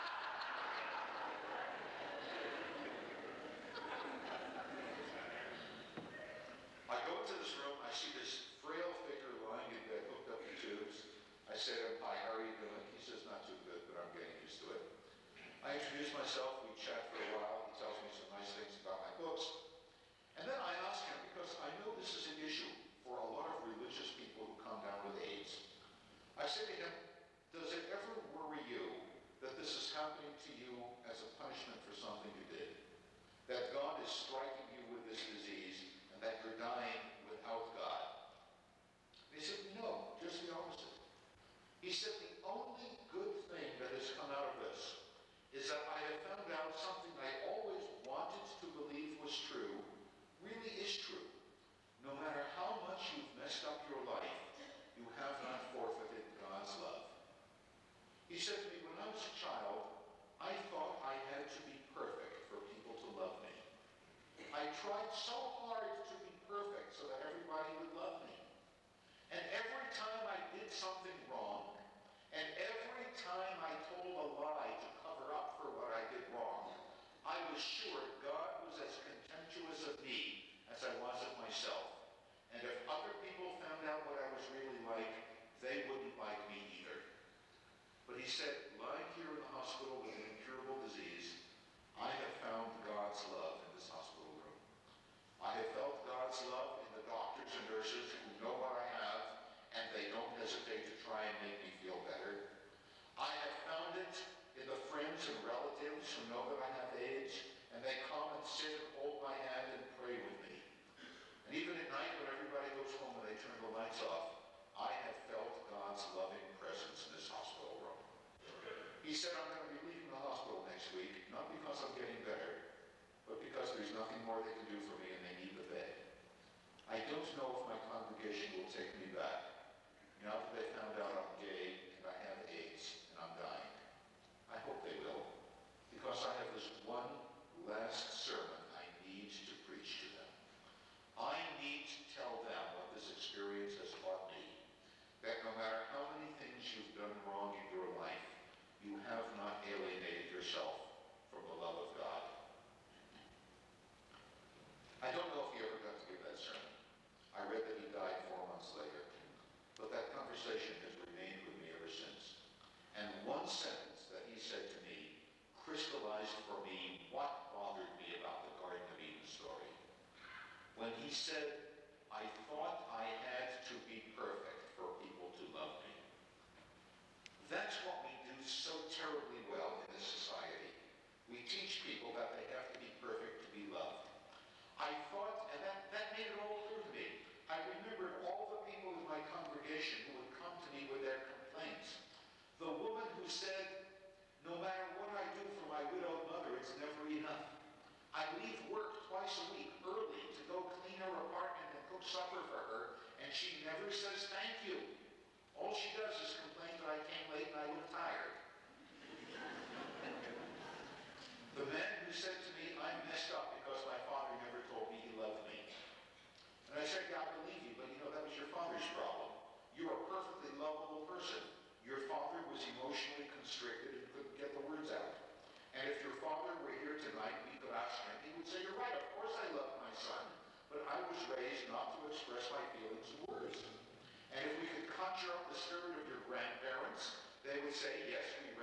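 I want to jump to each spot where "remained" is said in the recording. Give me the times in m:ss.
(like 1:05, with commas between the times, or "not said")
2:40.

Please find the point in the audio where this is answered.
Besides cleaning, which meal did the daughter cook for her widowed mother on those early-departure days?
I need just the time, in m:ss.
3:22.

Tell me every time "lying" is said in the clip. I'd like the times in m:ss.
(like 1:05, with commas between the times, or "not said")
0:09, 1:28.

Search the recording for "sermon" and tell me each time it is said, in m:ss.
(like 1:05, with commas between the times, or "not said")
2:18, 2:36.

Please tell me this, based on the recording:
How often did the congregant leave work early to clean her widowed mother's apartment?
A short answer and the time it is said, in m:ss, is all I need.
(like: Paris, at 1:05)
twice a week, at 3:19.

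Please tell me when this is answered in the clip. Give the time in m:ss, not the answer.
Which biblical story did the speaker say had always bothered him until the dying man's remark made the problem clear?
2:48.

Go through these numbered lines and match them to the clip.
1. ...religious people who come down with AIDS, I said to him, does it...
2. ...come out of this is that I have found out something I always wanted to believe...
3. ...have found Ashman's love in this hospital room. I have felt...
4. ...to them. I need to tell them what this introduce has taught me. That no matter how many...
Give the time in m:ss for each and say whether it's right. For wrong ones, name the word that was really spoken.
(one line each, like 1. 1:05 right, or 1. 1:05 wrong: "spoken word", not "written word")
1. 0:23 right
2. 0:44 right
3. 1:32 wrong: "God", not "Ashman"
4. 2:20 wrong: "experience", not "introduce".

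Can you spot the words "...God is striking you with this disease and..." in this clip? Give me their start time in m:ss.
0:33.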